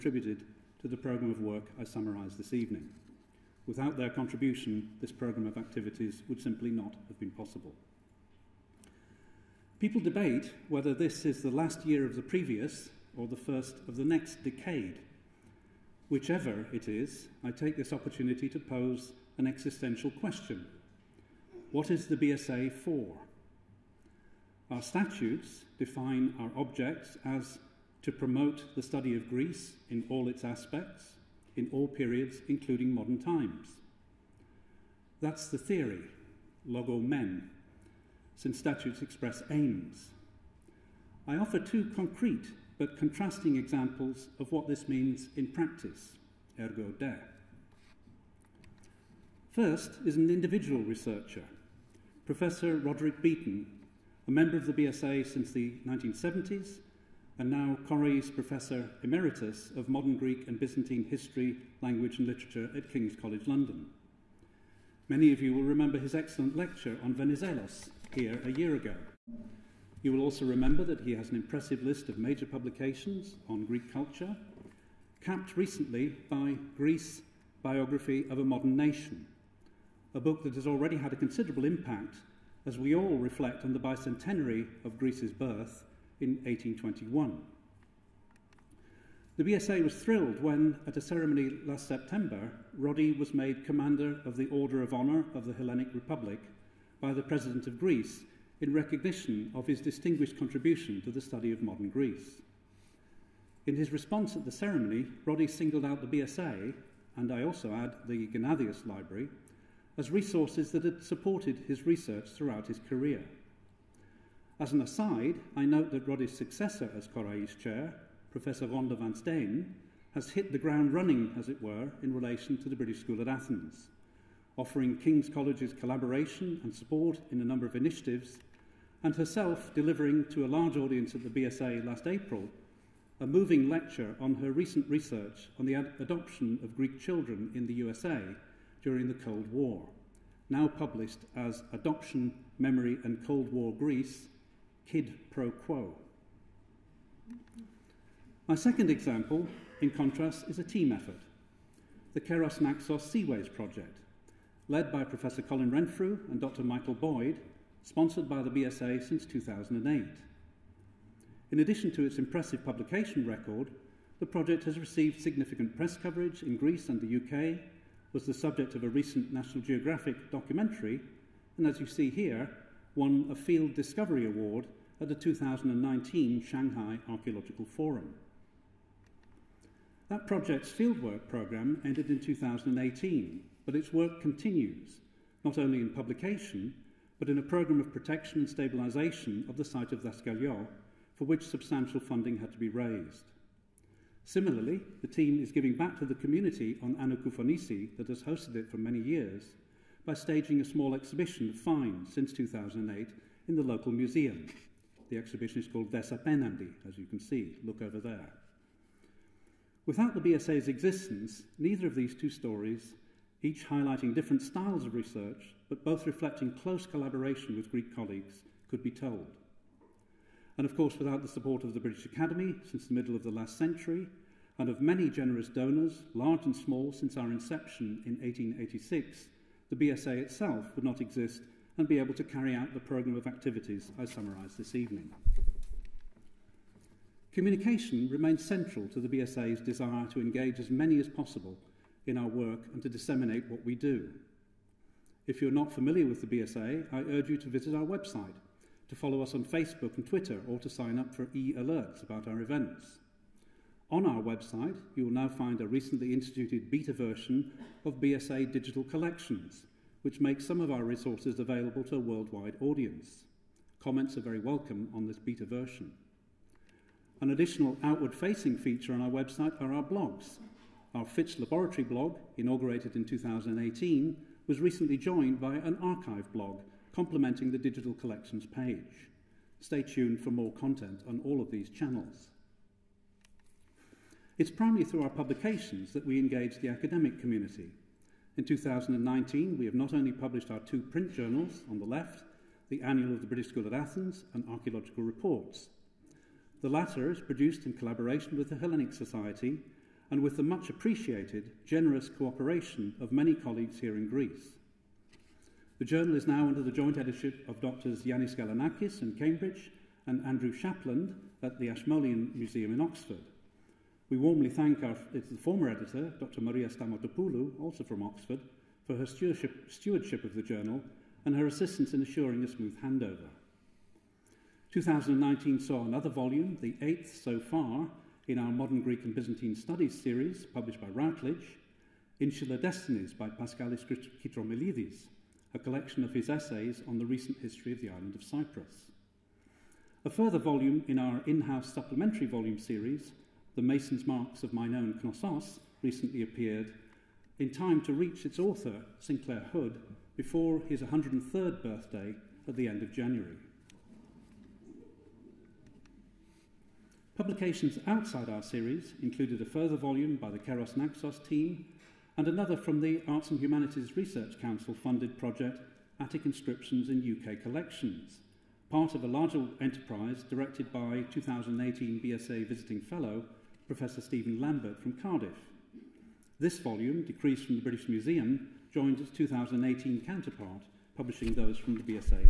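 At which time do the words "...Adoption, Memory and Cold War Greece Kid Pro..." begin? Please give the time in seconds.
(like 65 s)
141 s.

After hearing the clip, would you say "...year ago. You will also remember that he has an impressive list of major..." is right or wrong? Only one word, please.
right.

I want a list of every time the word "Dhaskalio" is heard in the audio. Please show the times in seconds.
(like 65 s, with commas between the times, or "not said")
190 s.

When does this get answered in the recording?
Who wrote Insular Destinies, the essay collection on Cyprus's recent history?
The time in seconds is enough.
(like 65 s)
333 s.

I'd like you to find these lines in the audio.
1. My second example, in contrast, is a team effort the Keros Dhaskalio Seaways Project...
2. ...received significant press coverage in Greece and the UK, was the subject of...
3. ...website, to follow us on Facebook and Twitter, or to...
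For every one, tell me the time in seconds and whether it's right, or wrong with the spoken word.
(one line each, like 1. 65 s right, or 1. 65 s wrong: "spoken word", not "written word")
1. 148 s wrong: "Naxos", not "Dhaskalio"
2. 164 s right
3. 247 s right.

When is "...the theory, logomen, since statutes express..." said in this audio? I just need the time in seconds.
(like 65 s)
35 s.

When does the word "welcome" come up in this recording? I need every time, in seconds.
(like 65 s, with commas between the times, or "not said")
264 s.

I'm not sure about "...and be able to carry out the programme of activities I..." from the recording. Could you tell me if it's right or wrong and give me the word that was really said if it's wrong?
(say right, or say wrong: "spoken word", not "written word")
right.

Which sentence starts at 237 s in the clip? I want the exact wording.
Communication remains central to the BSA's desire to engage as many as possible in our work and to disseminate what we do.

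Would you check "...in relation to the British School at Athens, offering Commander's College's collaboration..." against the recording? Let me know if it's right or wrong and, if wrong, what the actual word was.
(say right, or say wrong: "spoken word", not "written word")
wrong: "King", not "Commander".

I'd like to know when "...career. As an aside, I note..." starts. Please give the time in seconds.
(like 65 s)
112 s.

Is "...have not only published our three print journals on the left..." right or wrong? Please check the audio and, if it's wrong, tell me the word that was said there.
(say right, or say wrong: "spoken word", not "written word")
wrong: "two", not "three".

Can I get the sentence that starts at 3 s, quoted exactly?
Without their contribution, this programme of activities would simply not have been possible.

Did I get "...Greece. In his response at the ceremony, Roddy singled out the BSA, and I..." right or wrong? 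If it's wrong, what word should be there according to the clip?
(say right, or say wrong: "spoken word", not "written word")
right.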